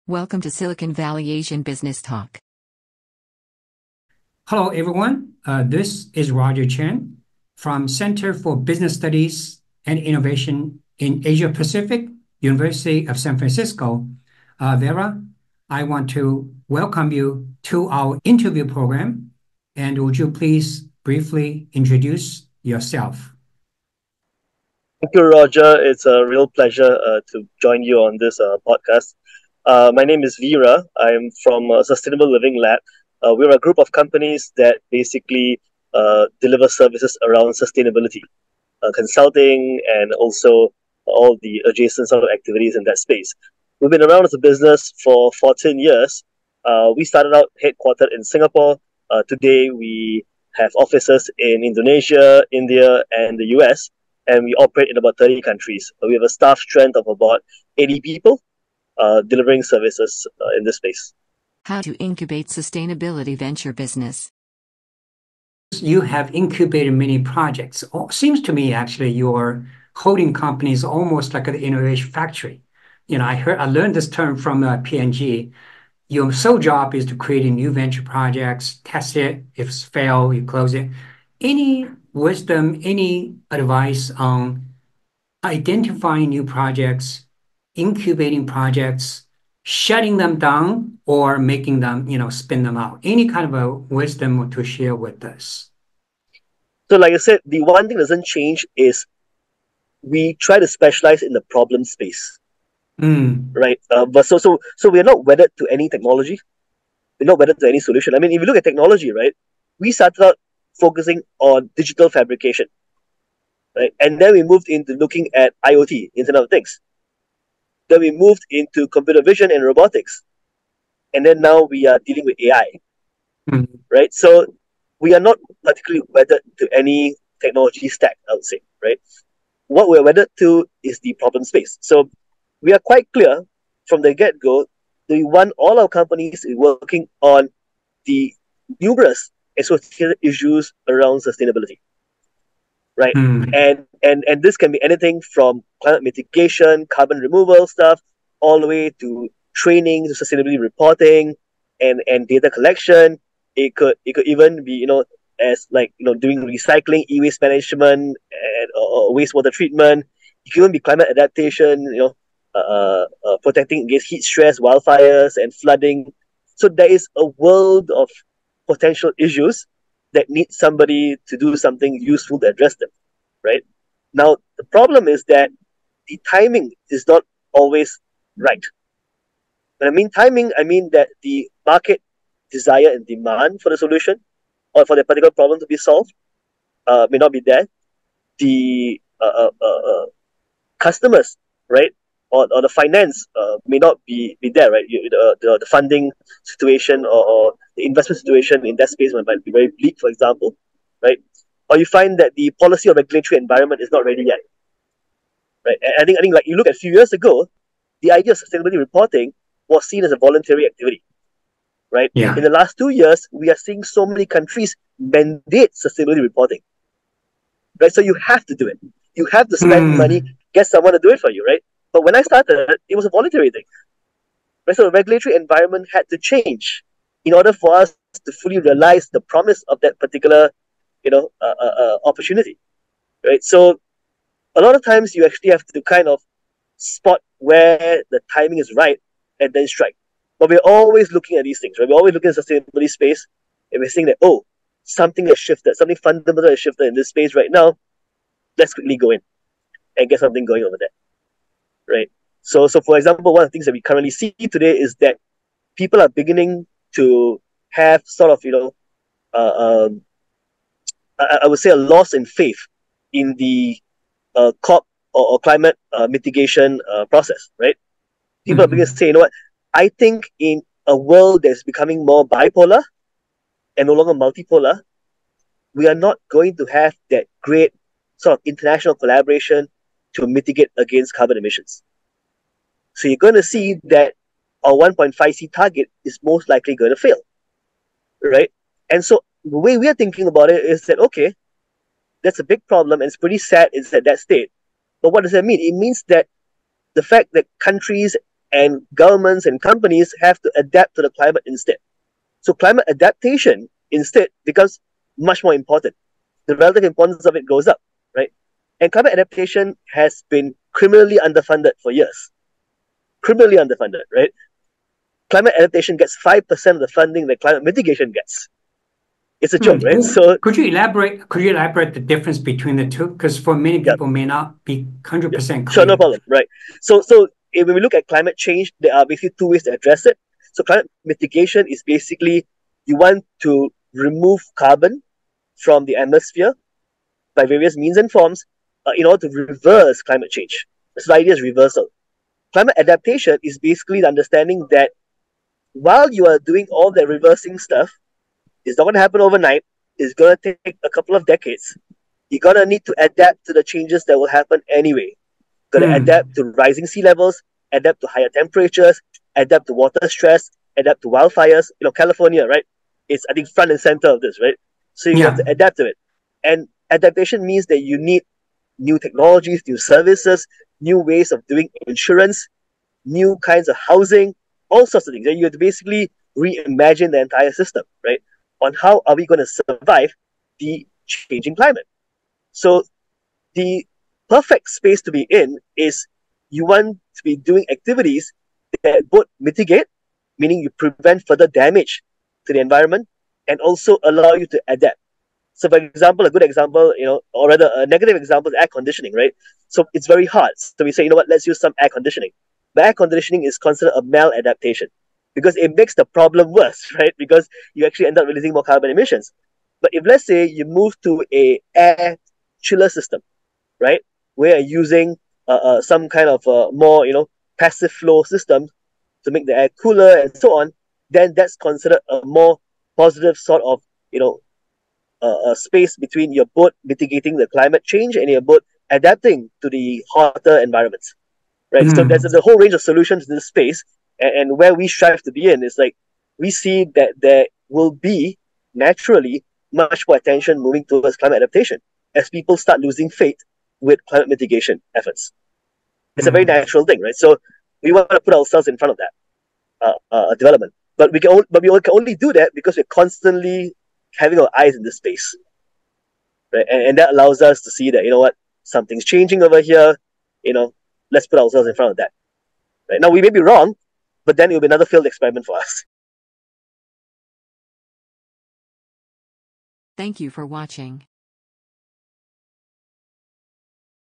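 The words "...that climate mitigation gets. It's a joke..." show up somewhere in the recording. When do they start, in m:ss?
5:17.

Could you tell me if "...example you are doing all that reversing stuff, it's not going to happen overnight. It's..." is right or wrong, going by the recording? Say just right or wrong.
wrong.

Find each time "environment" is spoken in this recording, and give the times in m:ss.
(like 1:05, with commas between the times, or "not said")
3:23, 3:45, 6:32, 7:10.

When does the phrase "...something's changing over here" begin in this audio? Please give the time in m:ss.
7:38.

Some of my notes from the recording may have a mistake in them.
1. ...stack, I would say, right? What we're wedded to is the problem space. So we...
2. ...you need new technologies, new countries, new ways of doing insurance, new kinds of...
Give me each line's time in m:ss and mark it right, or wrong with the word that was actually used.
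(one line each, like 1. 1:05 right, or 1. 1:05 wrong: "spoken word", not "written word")
1. 2:07 right
2. 6:07 wrong: "services", not "countries".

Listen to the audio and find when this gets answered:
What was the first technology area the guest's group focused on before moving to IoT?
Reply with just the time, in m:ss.
1:51.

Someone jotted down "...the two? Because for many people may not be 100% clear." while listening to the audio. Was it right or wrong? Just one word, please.
right.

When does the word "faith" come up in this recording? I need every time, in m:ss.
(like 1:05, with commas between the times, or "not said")
4:22, 7:23.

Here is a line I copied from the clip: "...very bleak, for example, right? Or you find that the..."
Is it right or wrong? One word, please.
right.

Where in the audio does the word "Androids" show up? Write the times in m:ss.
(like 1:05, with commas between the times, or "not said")
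not said.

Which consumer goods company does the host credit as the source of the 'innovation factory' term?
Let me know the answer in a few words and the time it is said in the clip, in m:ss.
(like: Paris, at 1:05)
P&G, at 1:14.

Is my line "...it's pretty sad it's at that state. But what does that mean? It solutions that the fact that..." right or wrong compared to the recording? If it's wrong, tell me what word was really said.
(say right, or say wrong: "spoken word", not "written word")
wrong: "means", not "solutions".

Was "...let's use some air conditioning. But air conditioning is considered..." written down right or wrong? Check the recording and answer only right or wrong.
right.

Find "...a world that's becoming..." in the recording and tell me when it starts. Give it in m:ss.
4:30.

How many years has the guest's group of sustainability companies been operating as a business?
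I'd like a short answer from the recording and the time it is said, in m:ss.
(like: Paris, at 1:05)
14 years, at 0:45.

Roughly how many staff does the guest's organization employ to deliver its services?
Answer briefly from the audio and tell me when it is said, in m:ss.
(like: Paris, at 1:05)
80, at 0:57.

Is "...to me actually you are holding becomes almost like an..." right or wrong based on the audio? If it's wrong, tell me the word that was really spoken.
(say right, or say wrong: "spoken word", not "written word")
wrong: "companies", not "becomes".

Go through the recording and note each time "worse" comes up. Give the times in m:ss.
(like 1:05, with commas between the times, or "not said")
6:46.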